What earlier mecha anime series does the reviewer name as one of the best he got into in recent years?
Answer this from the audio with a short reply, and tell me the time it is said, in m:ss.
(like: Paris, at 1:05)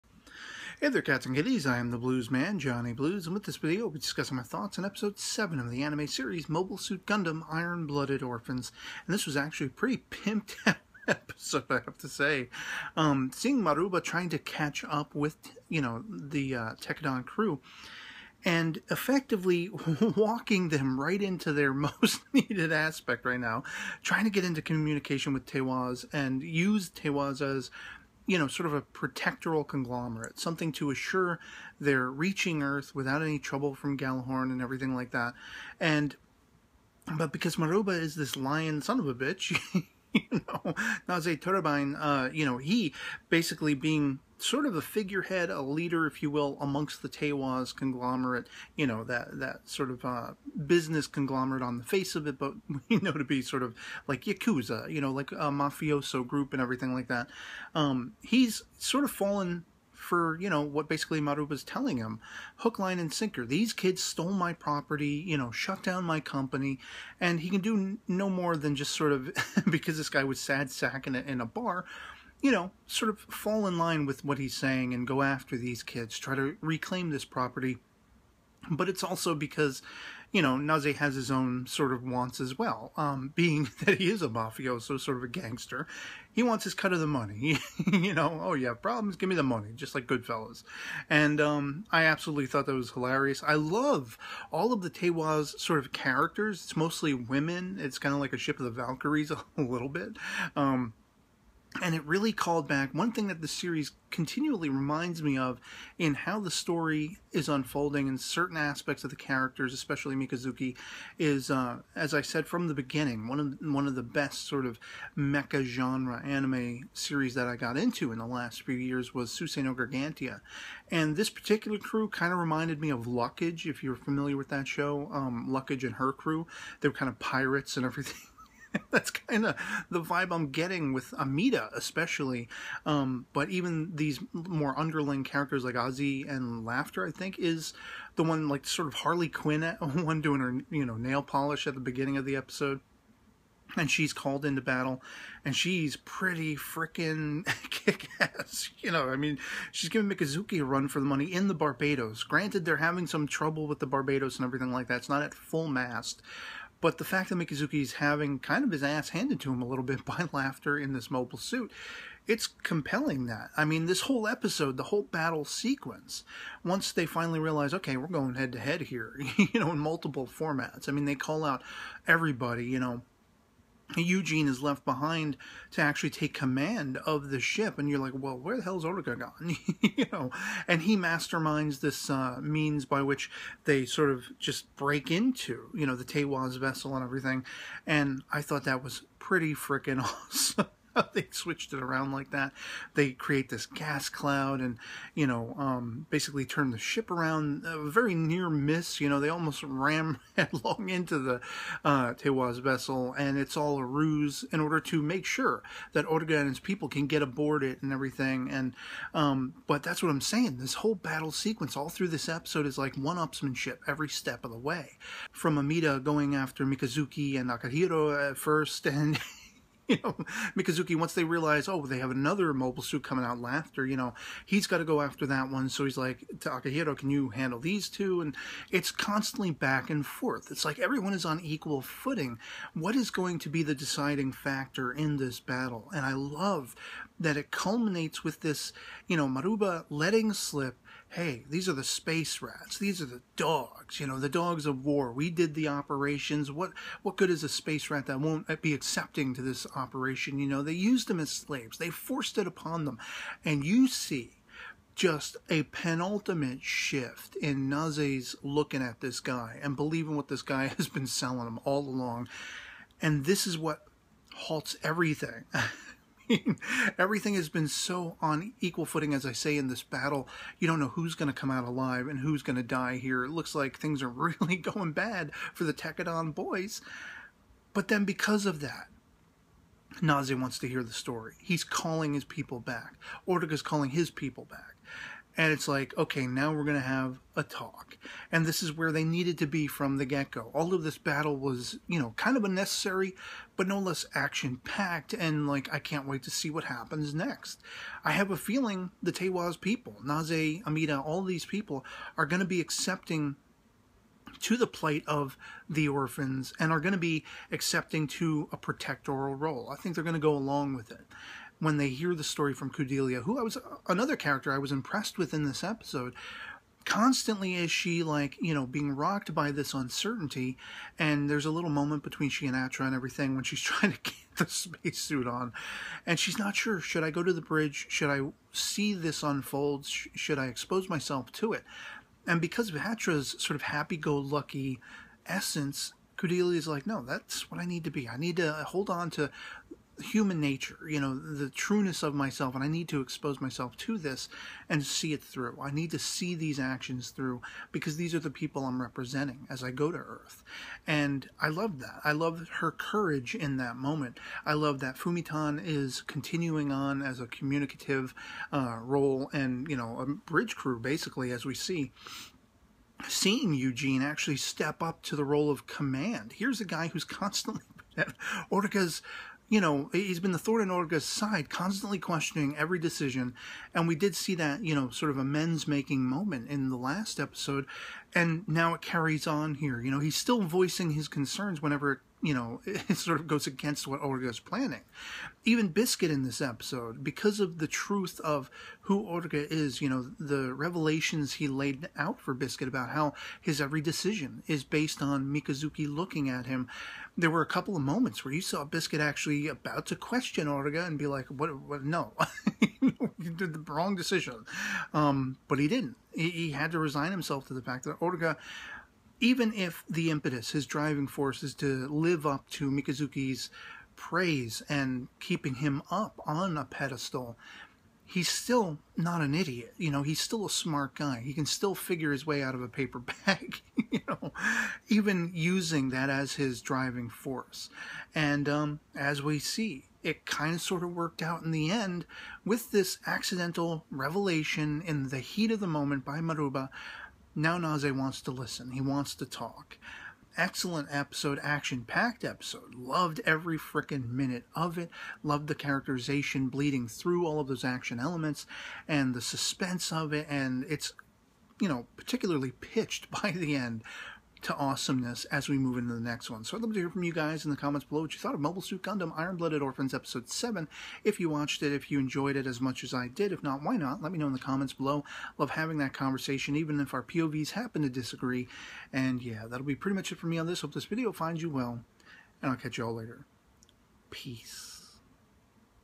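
Suisei no Gargantia, at 1:59.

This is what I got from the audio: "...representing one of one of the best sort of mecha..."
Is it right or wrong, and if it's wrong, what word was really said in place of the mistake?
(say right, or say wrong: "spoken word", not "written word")
wrong: "beginning", not "representing".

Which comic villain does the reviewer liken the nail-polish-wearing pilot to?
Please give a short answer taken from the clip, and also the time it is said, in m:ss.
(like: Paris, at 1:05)
Harley Quinn, at 2:18.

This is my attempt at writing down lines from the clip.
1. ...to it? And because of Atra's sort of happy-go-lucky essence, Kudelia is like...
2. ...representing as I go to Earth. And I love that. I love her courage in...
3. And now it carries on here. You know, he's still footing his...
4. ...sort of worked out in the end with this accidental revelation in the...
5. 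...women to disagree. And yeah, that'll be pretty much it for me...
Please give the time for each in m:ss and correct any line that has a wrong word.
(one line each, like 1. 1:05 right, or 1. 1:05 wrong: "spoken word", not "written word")
1. 5:31 right
2. 5:48 right
3. 6:18 wrong: "voicing", not "footing"
4. 7:10 right
5. 7:47 wrong: "happen", not "women".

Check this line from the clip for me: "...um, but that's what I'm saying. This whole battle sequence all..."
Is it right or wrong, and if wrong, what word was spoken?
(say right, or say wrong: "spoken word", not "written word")
right.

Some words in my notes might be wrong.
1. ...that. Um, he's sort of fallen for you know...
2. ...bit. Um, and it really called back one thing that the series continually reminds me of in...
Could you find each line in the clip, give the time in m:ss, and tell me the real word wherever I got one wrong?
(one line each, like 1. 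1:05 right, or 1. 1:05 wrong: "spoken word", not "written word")
1. 0:57 right
2. 1:39 right.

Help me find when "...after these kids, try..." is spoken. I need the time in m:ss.
1:15.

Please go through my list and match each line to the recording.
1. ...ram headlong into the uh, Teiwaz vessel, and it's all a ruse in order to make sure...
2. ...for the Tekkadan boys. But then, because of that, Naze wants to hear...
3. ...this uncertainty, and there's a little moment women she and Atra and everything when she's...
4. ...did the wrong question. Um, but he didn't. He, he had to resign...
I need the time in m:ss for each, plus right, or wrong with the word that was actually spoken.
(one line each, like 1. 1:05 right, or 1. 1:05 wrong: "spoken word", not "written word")
1. 3:19 right
2. 4:35 right
3. 5:19 wrong: "between", not "women"
4. 6:43 wrong: "decision", not "question".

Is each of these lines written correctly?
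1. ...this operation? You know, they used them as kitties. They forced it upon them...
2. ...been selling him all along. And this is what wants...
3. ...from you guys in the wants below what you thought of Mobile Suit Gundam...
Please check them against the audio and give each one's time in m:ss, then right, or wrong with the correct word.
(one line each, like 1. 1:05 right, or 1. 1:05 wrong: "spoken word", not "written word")
1. 4:09 wrong: "slaves", not "kitties"
2. 4:20 wrong: "halts", not "wants"
3. 7:36 wrong: "comments", not "wants".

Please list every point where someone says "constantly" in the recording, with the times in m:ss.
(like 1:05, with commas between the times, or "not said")
3:48, 5:16, 6:07, 6:11.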